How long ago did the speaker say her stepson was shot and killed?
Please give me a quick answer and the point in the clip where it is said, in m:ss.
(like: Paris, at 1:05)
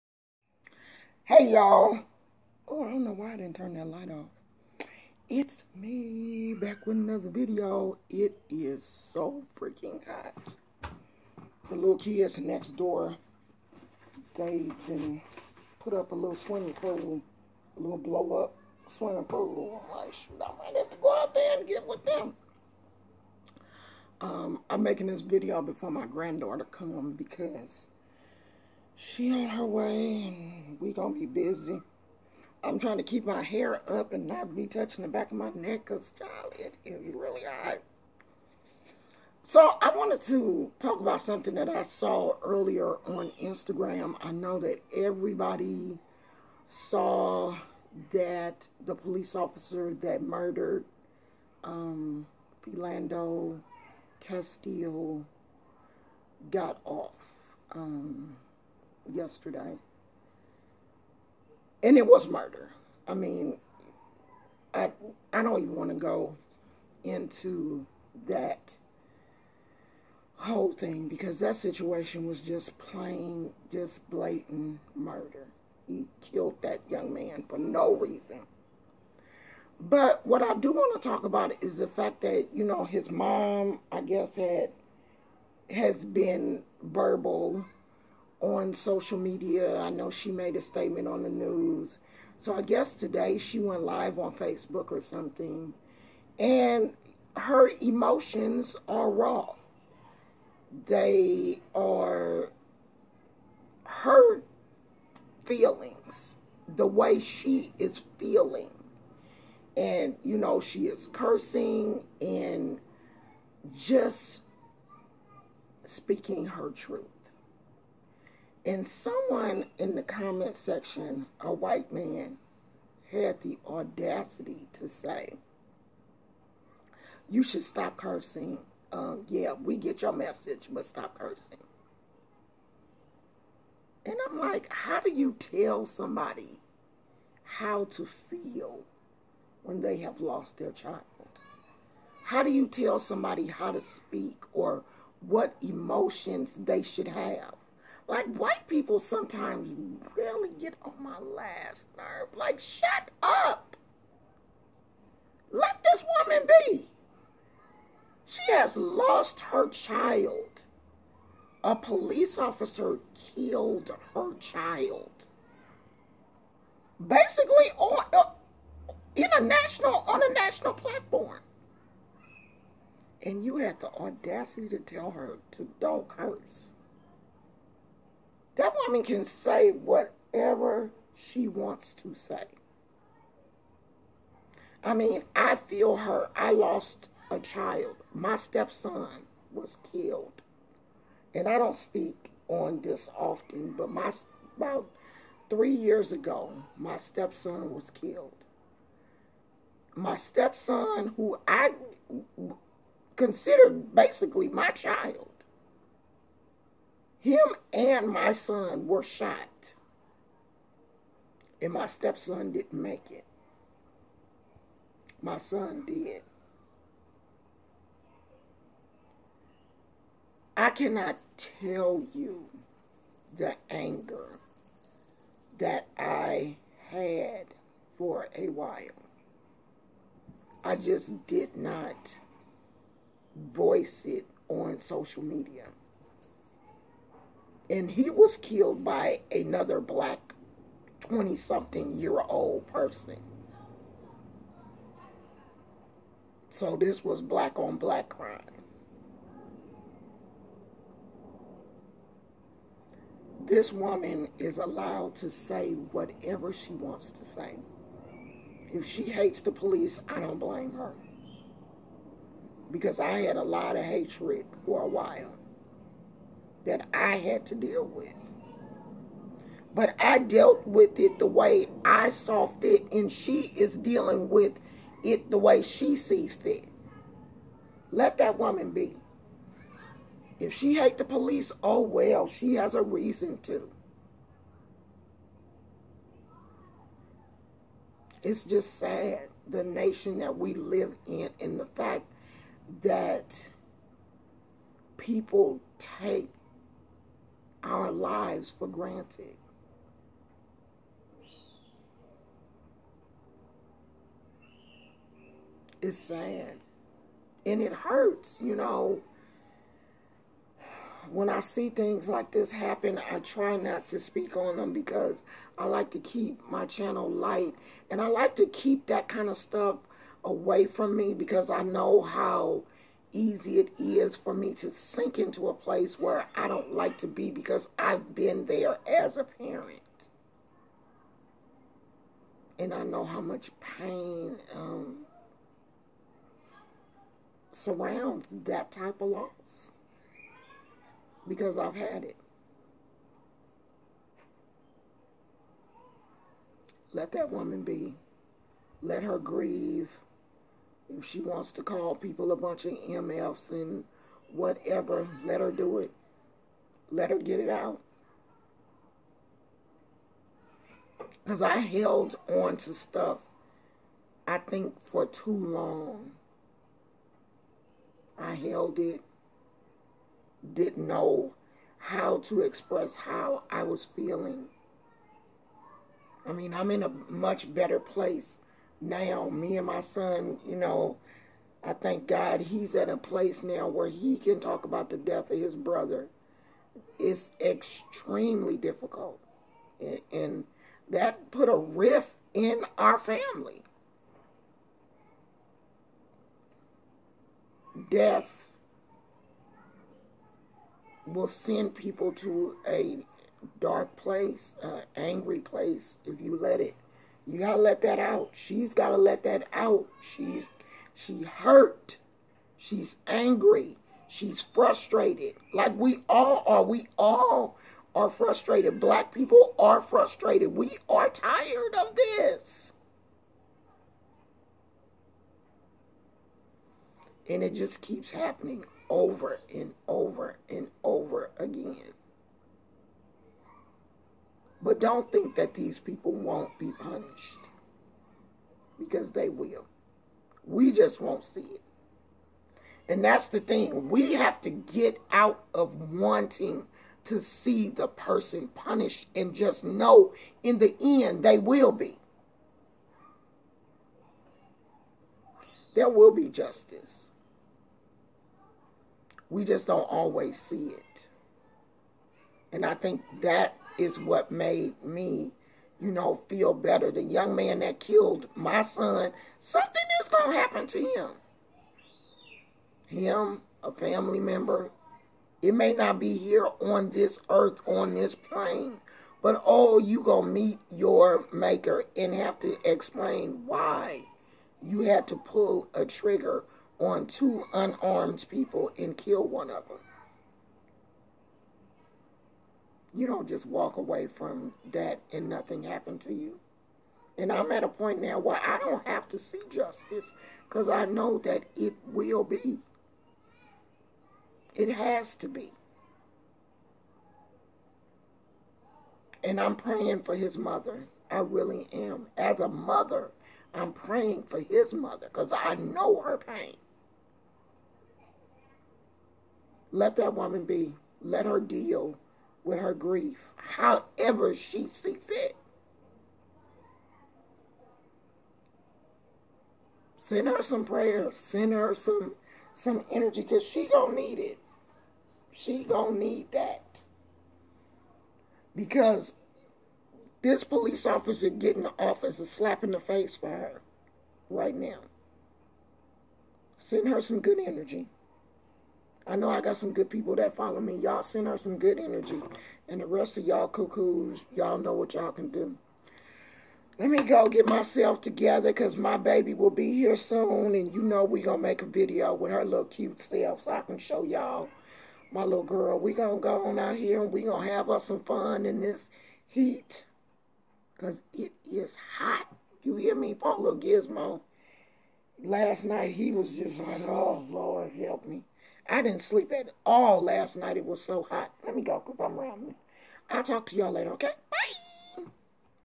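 About 3 years ago, at 3:15.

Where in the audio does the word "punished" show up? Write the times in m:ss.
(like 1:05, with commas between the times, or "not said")
7:16, 7:28.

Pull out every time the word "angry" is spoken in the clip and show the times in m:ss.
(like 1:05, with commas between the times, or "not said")
6:44, 6:53.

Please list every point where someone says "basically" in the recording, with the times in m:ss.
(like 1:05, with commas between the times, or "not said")
2:47, 3:23.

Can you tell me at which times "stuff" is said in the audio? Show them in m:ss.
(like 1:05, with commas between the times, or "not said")
5:19, 6:02.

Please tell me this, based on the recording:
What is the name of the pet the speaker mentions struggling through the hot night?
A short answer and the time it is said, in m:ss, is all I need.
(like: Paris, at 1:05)
Gizmo, at 9:33.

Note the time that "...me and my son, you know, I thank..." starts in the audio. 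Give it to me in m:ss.
6:19.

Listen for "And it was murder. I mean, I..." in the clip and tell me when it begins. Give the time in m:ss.
1:01.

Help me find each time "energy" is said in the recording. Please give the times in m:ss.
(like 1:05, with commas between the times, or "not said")
8:52, 9:07, 9:11.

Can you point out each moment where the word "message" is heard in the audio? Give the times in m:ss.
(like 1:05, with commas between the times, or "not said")
2:10.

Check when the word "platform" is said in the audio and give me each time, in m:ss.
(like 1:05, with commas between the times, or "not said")
2:50.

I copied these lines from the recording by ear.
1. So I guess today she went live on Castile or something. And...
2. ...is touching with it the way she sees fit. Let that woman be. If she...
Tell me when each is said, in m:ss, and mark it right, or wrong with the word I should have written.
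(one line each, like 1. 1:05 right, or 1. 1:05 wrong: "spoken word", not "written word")
1. 1:32 wrong: "Facebook", not "Castile"
2. 4:33 wrong: "dealing", not "touching".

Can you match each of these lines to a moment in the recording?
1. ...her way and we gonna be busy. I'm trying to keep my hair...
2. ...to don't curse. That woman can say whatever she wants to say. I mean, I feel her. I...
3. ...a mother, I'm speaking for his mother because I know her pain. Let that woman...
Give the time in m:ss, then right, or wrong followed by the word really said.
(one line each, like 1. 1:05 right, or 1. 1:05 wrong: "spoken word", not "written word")
1. 0:29 right
2. 2:55 right
3. 8:32 wrong: "praying", not "speaking".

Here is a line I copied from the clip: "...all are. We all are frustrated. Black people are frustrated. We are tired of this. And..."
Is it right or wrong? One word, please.
right.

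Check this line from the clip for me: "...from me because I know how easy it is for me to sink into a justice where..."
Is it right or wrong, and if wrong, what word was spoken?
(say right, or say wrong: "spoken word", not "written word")
wrong: "place", not "justice".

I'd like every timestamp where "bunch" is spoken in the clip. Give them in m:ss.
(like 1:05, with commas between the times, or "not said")
5:52.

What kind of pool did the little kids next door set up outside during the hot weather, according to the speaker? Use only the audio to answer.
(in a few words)
Blow up swimming pool.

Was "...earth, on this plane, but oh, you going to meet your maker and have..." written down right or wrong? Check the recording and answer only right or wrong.
right.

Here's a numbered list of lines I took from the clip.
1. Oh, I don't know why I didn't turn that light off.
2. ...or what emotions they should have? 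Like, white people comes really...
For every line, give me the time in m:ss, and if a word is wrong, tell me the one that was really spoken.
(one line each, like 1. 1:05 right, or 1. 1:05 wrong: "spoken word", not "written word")
1. 0:02 right
2. 2:24 wrong: "sometimes", not "comes".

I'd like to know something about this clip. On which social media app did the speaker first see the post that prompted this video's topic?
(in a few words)
Instagram.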